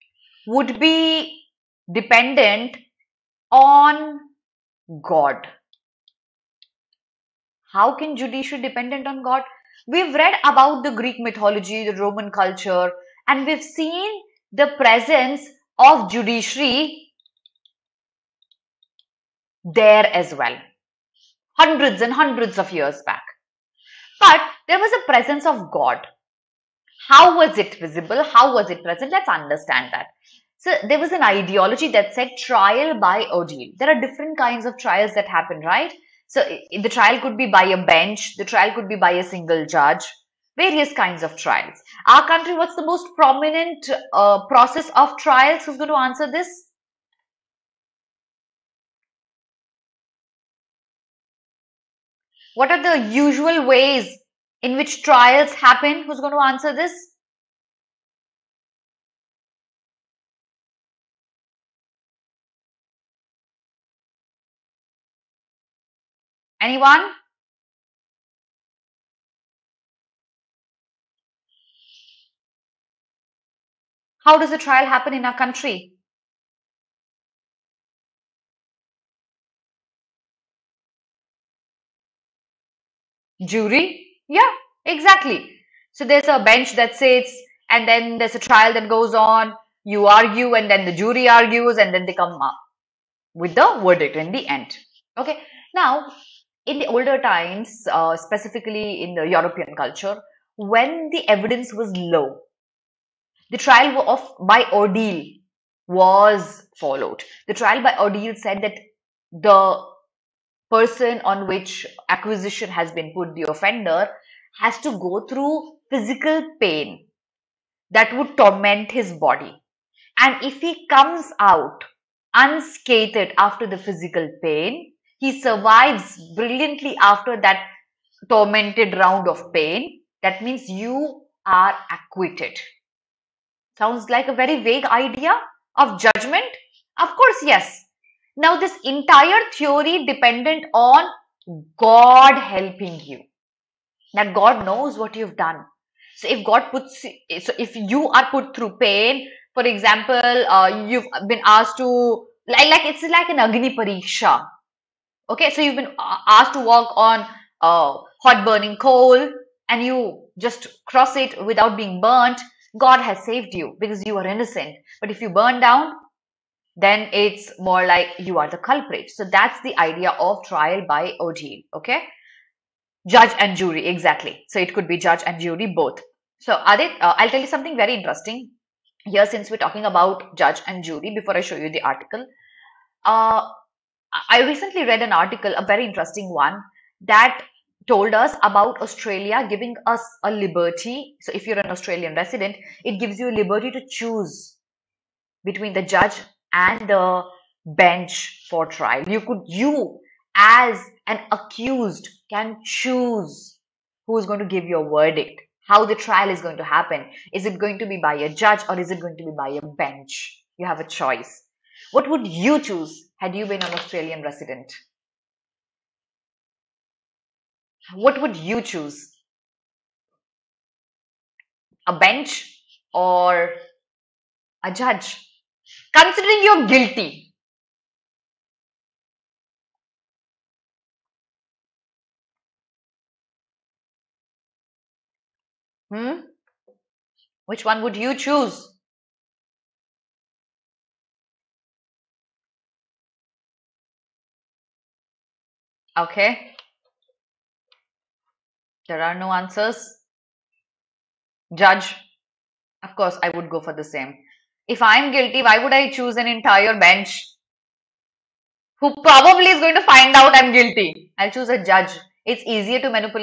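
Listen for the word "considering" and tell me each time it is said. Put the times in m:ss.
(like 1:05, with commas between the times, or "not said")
3:45.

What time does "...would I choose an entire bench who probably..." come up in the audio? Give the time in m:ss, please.
4:15.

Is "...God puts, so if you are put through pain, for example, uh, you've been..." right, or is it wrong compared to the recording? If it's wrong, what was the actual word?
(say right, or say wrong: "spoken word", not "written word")
right.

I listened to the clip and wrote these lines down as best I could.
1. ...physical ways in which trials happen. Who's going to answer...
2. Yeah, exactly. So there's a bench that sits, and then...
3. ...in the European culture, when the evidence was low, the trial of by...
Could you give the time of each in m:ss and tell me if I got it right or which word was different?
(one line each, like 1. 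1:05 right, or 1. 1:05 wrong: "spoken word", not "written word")
1. 0:53 wrong: "usual", not "physical"
2. 1:24 right
3. 1:39 right.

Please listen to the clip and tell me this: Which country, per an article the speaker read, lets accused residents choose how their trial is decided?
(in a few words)
Australia.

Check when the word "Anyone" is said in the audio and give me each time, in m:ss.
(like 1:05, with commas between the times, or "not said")
1:06.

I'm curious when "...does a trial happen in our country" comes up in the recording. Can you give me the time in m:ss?
1:14.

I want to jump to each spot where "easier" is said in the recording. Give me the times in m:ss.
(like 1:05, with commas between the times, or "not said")
4:22.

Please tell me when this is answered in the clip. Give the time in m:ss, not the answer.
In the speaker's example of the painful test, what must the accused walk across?
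2:38.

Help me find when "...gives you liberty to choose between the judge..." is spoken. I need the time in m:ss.
3:12.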